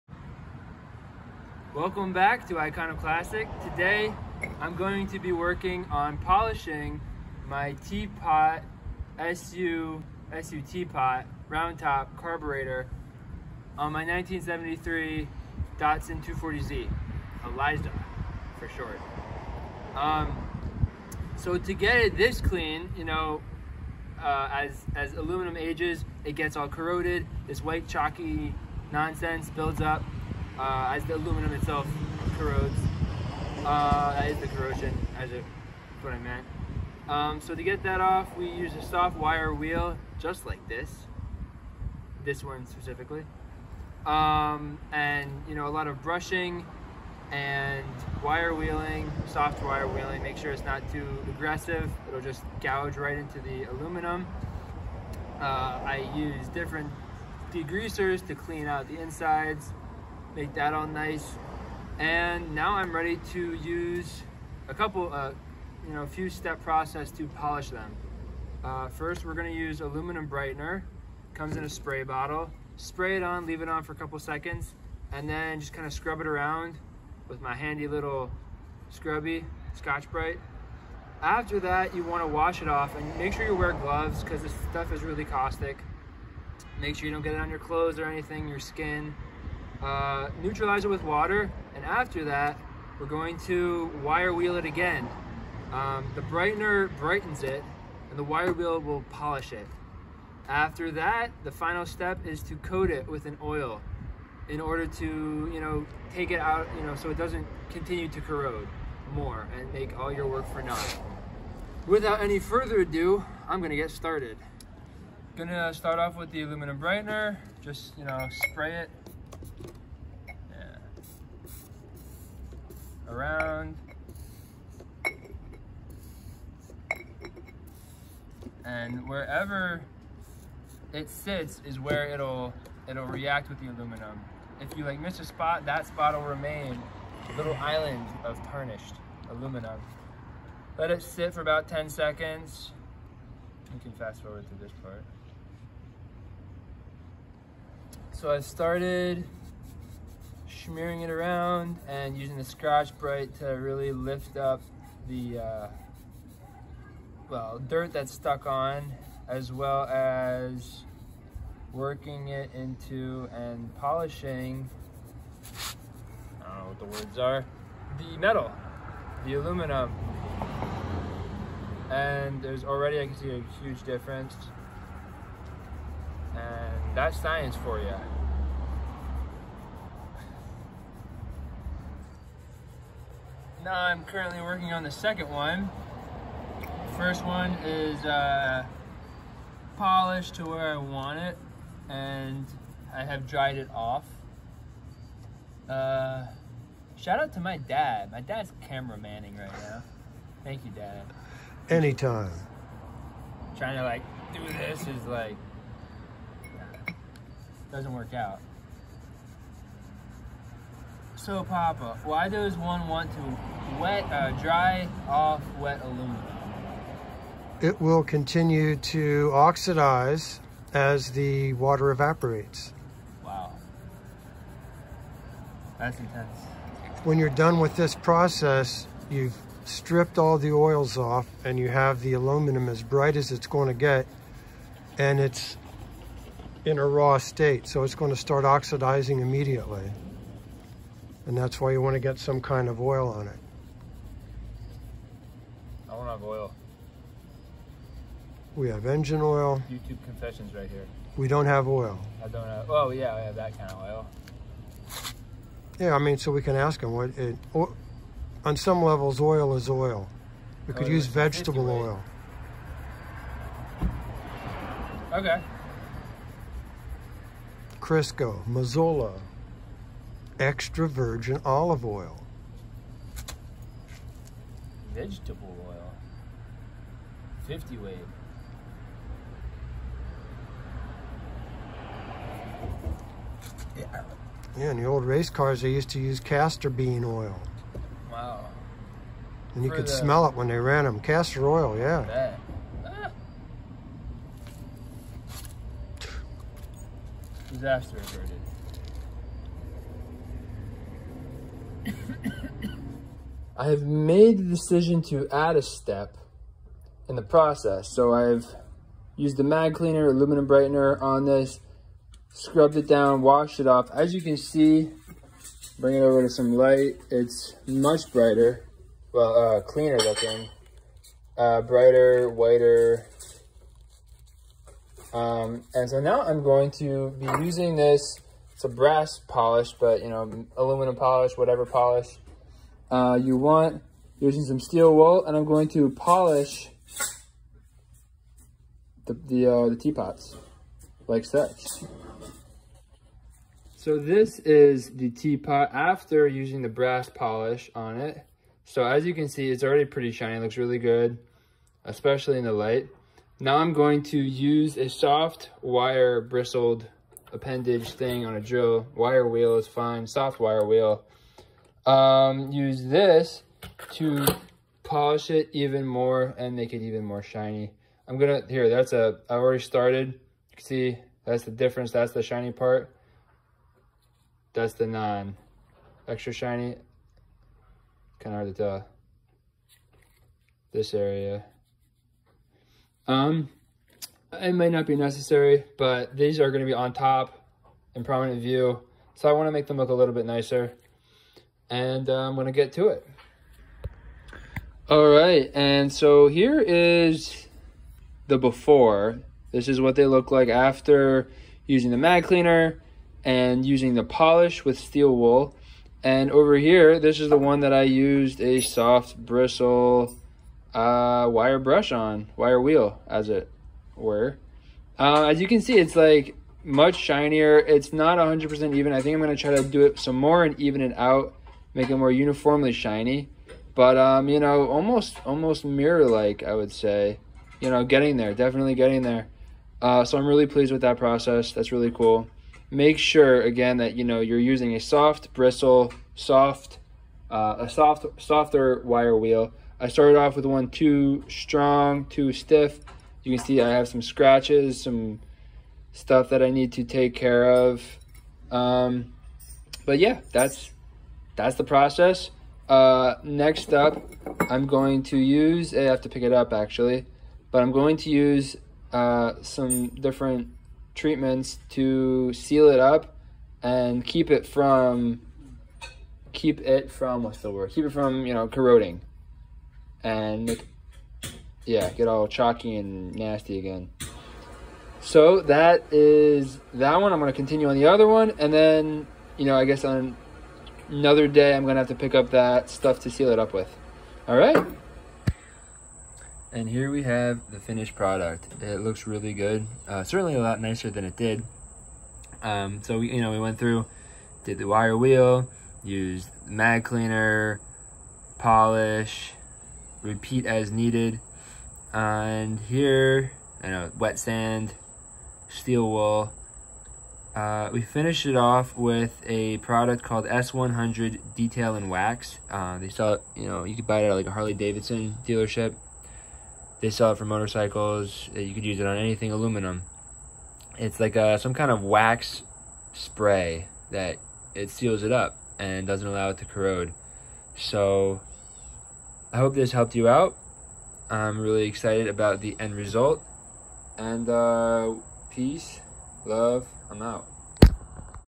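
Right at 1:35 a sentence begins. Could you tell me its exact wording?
Um, the brightener brightens it, and the wire wheel will polish it.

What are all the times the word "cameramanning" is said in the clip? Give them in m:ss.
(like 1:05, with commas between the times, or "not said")
3:18.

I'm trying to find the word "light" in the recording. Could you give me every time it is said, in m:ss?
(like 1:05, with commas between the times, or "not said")
5:16, 5:52.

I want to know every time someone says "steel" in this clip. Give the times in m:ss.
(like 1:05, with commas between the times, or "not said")
5:34, 6:44, 8:25.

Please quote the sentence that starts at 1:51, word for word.
Without any further ado, I'm gonna get started.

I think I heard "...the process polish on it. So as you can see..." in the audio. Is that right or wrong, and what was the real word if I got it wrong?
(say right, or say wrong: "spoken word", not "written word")
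wrong: "brass", not "process".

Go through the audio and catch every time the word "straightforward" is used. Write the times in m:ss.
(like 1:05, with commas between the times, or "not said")
not said.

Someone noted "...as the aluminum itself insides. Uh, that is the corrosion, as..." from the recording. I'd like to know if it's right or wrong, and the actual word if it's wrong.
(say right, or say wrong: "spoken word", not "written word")
wrong: "corrodes", not "insides".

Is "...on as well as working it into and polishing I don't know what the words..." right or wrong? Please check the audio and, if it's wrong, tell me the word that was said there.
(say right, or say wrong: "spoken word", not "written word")
right.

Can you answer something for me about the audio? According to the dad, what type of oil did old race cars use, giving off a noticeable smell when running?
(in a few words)
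Castor bean oil.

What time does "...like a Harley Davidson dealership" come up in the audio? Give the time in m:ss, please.
8:34.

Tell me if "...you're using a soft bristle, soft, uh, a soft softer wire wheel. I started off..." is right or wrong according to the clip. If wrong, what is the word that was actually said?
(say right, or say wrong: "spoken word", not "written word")
right.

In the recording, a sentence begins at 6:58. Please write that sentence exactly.
I think I'm going to try to do it some more and even it out make it more uniformly shiny.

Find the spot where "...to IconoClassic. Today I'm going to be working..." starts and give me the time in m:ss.
0:02.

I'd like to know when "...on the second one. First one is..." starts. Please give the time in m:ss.
3:04.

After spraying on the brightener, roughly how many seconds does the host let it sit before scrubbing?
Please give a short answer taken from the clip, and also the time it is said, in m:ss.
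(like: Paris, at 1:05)
10, at 2:21.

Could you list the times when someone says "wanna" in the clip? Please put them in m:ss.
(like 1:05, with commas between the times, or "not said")
1:22, 6:29.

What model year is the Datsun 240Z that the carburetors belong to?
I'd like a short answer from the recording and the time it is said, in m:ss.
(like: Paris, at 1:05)
1973, at 0:14.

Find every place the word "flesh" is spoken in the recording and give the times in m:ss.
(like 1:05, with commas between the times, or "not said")
not said.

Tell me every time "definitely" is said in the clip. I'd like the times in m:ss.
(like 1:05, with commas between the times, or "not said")
7:08.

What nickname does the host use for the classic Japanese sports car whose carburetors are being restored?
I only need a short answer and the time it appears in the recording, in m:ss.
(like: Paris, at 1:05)
Eliza, at 0:17.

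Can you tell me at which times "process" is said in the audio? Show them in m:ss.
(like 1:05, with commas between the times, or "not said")
1:06, 3:47, 5:07, 7:10, 7:31.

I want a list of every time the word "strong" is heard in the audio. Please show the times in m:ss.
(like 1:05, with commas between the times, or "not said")
7:21.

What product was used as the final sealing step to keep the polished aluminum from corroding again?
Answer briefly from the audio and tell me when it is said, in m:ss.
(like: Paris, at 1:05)
S100 Detail and Wax, at 8:30.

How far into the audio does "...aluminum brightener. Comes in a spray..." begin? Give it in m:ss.
1:09.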